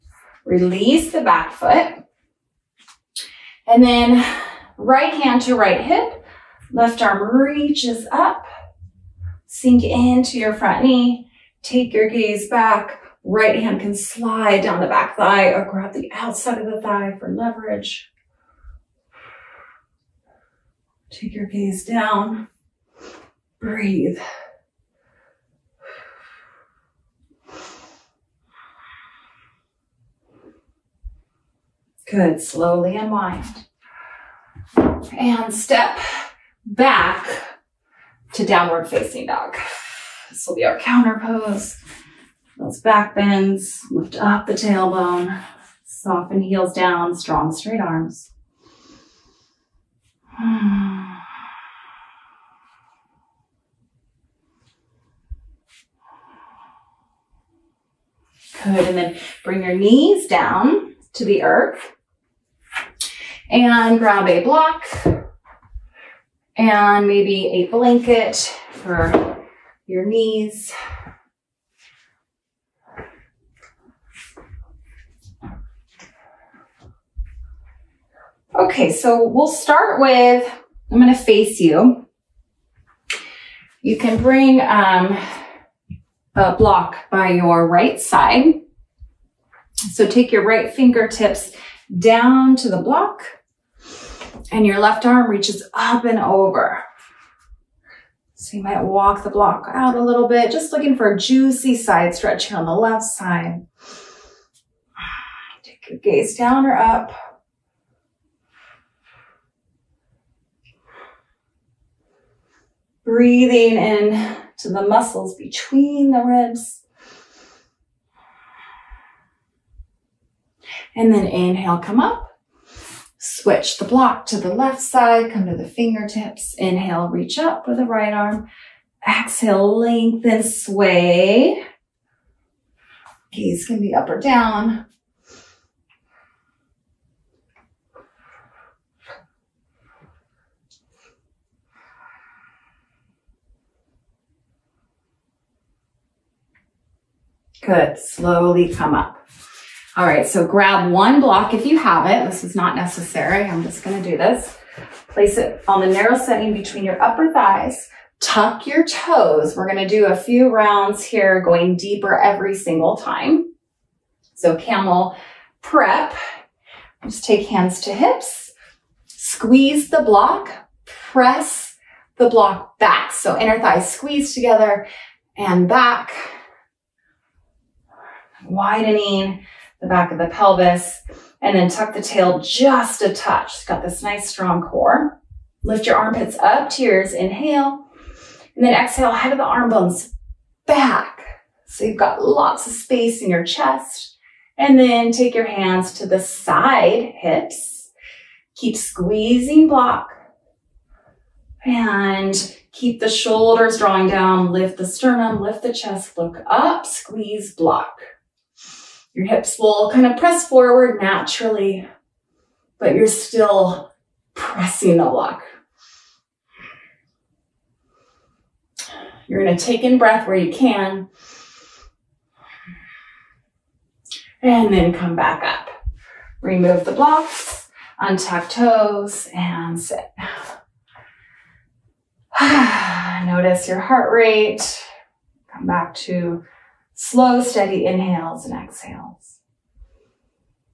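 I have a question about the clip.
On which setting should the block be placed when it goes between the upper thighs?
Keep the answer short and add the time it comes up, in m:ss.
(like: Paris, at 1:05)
Narrow setting, at 2:35.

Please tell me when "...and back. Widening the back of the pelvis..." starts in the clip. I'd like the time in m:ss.
2:55.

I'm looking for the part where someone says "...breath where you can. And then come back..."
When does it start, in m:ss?
3:39.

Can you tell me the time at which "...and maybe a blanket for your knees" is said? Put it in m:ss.
1:06.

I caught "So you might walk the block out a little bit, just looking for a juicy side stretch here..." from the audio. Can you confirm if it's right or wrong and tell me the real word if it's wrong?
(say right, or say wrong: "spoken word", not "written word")
right.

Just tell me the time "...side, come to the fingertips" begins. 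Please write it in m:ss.
2:04.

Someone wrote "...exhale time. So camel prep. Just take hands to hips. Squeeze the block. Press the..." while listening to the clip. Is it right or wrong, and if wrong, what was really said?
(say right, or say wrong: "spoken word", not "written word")
wrong: "single", not "exhale".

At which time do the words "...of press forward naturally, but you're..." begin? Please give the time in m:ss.
3:30.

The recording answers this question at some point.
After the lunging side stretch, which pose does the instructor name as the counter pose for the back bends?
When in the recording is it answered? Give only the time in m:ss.
0:38.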